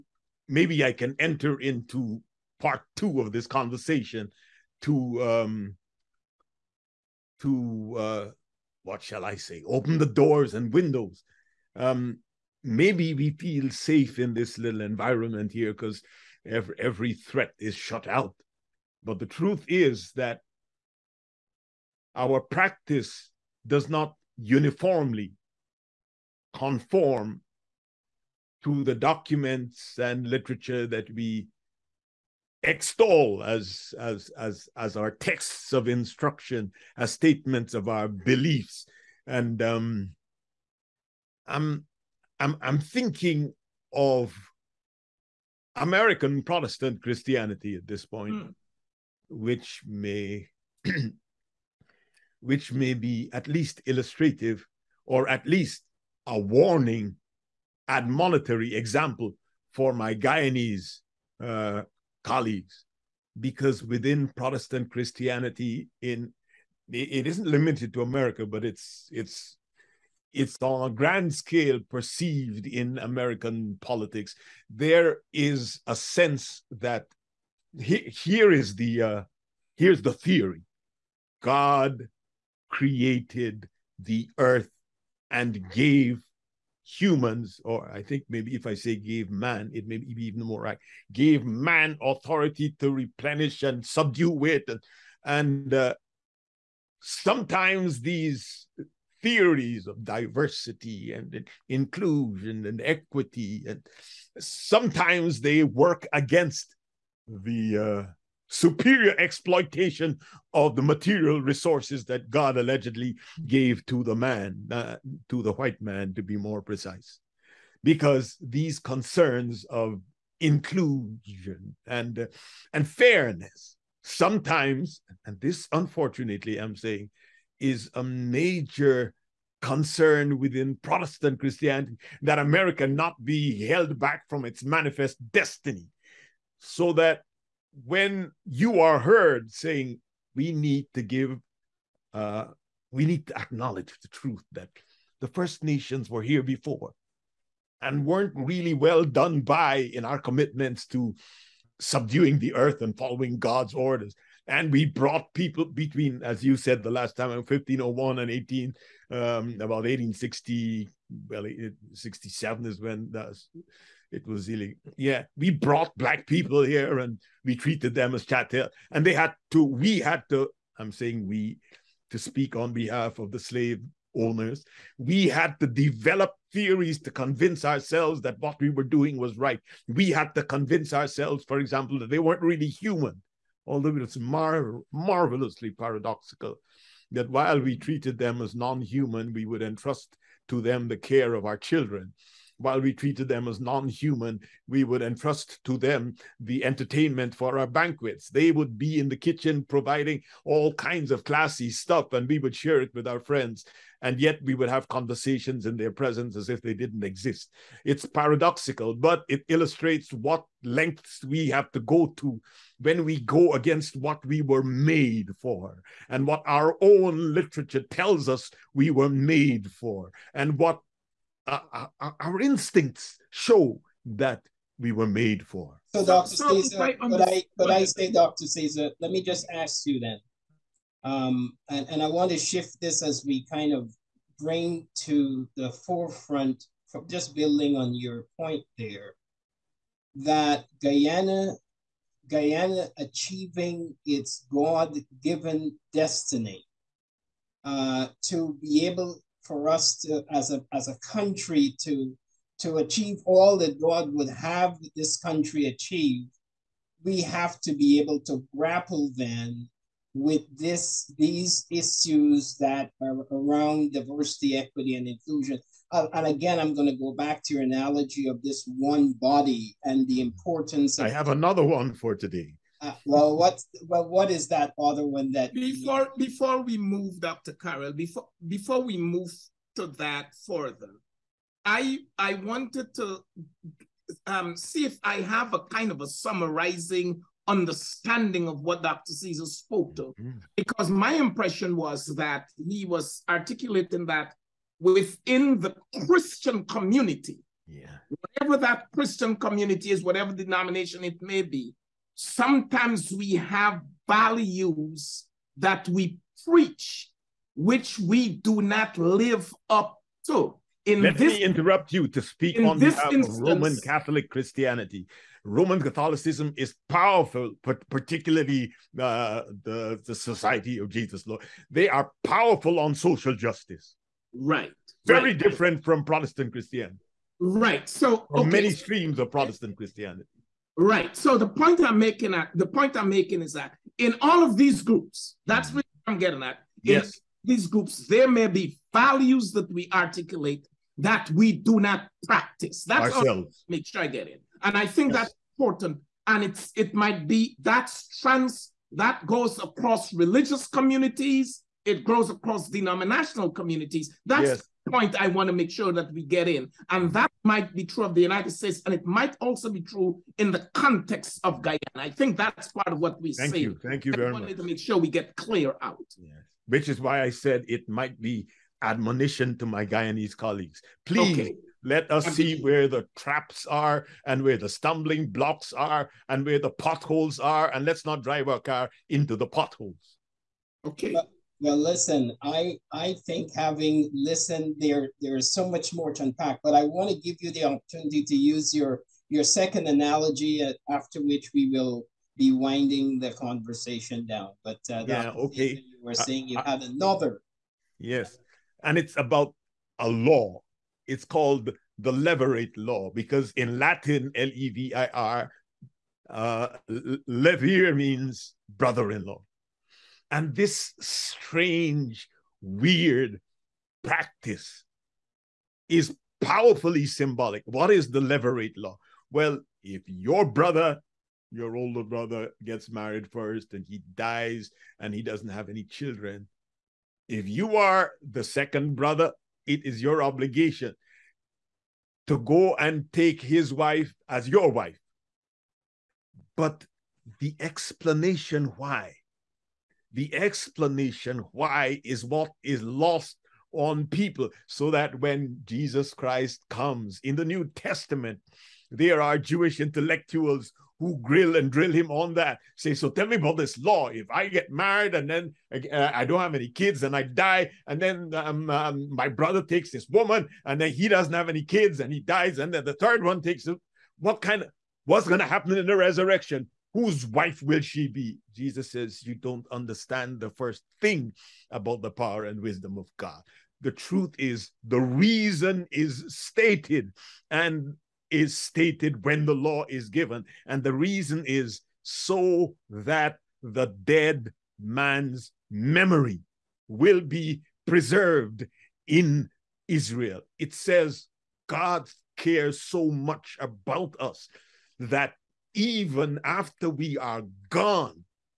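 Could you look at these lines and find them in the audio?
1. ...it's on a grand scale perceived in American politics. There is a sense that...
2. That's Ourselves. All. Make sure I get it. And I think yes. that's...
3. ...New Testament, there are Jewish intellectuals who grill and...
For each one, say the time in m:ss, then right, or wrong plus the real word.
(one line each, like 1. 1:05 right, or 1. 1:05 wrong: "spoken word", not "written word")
1. 1:10 right
2. 5:42 right
3. 7:27 right.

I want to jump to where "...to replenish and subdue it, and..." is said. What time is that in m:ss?
1:32.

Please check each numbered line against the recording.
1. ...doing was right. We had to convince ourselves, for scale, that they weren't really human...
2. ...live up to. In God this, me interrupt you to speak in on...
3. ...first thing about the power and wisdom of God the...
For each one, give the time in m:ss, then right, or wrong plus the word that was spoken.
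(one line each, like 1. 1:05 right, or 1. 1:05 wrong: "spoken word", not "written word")
1. 2:58 wrong: "example", not "scale"
2. 5:08 wrong: "Let", not "God"
3. 7:50 right.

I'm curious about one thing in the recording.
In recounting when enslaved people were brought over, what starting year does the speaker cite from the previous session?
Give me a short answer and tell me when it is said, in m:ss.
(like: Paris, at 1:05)
1501, at 2:37.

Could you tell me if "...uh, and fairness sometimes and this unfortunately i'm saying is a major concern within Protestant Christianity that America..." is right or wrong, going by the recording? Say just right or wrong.
right.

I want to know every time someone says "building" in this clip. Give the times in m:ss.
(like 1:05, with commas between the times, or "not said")
3:57.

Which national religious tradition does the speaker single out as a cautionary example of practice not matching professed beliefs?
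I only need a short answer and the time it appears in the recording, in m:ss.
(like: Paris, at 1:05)
American Protestant Christianity, at 0:45.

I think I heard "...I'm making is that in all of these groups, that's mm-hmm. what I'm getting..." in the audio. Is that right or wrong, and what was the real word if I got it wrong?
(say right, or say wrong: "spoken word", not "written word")
right.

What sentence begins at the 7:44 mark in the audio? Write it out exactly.
What kind of what's going to happen in the resurrection?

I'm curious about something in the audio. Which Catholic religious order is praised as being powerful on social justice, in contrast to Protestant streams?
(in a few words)
Society of Jesus.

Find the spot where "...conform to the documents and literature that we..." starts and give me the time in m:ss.
0:26.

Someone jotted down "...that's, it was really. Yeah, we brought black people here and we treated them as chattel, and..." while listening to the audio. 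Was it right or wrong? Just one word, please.
right.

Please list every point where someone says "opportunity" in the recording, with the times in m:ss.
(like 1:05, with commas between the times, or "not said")
6:27.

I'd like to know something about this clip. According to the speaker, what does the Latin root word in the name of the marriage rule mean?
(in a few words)
brother in law.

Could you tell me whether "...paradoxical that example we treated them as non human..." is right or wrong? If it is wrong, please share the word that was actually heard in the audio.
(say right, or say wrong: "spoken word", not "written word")
wrong: "while", not "example".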